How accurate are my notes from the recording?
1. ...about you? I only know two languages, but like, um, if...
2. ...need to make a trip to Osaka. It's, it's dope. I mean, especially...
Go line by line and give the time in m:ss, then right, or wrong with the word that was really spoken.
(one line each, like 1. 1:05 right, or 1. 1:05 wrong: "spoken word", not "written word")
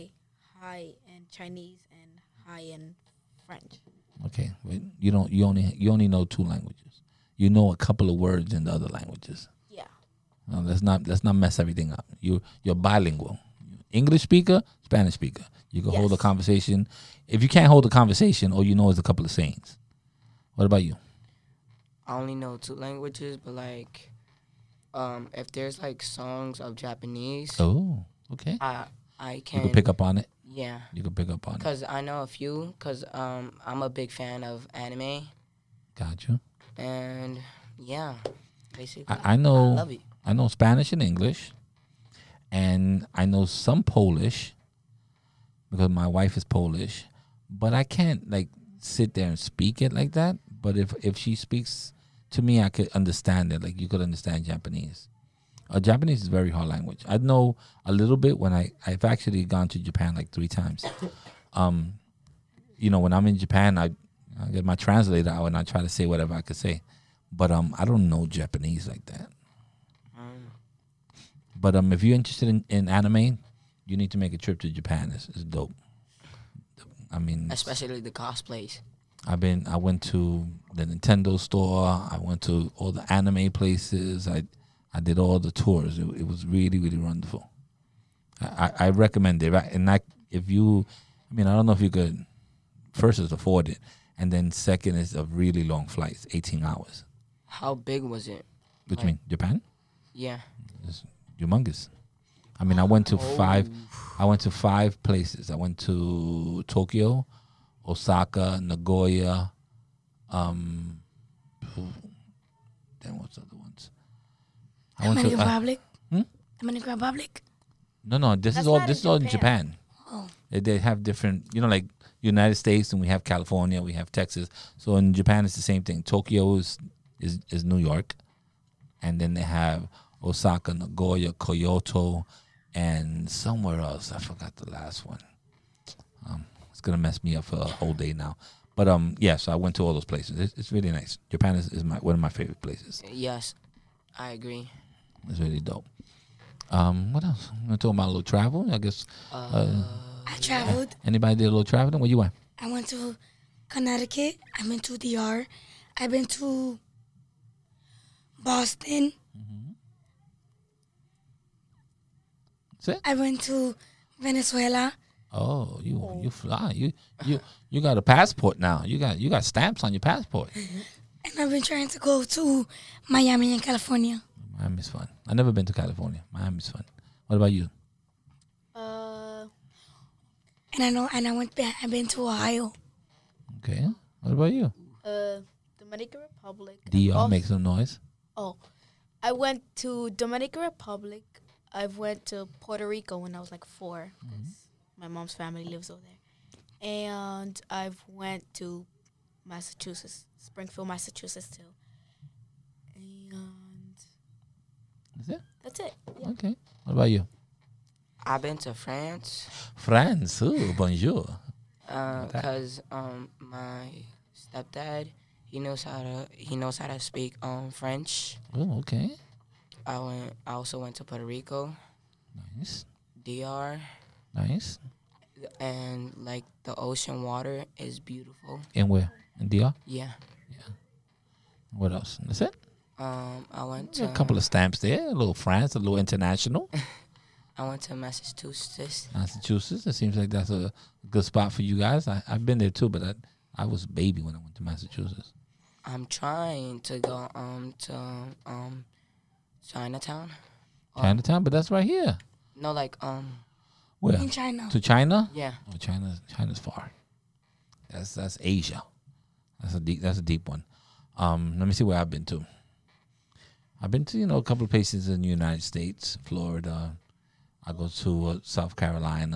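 1. 0:20 right
2. 1:13 wrong: "Japan", not "Osaka".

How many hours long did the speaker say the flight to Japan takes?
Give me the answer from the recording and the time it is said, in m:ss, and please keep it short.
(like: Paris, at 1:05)
18, at 1:36.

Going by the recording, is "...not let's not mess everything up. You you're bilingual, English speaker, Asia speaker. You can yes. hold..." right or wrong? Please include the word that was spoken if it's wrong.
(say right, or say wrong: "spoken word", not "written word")
wrong: "Spanish", not "Asia".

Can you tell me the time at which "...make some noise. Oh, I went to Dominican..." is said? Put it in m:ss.
3:07.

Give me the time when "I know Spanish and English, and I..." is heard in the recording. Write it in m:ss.
0:40.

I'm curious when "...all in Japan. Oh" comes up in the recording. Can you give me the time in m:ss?
1:59.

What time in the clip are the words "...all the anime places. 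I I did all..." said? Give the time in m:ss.
1:22.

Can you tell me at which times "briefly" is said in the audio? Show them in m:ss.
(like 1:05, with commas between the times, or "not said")
not said.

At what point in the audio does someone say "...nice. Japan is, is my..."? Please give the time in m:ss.
2:20.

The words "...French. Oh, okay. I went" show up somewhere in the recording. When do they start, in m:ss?
3:37.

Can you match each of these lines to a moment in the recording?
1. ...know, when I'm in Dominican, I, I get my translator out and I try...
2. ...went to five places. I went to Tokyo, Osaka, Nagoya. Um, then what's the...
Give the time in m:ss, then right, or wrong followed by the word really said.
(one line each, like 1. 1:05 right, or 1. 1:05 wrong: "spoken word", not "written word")
1. 1:02 wrong: "Japan", not "Dominican"
2. 1:44 right.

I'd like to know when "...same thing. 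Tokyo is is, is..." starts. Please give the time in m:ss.
2:05.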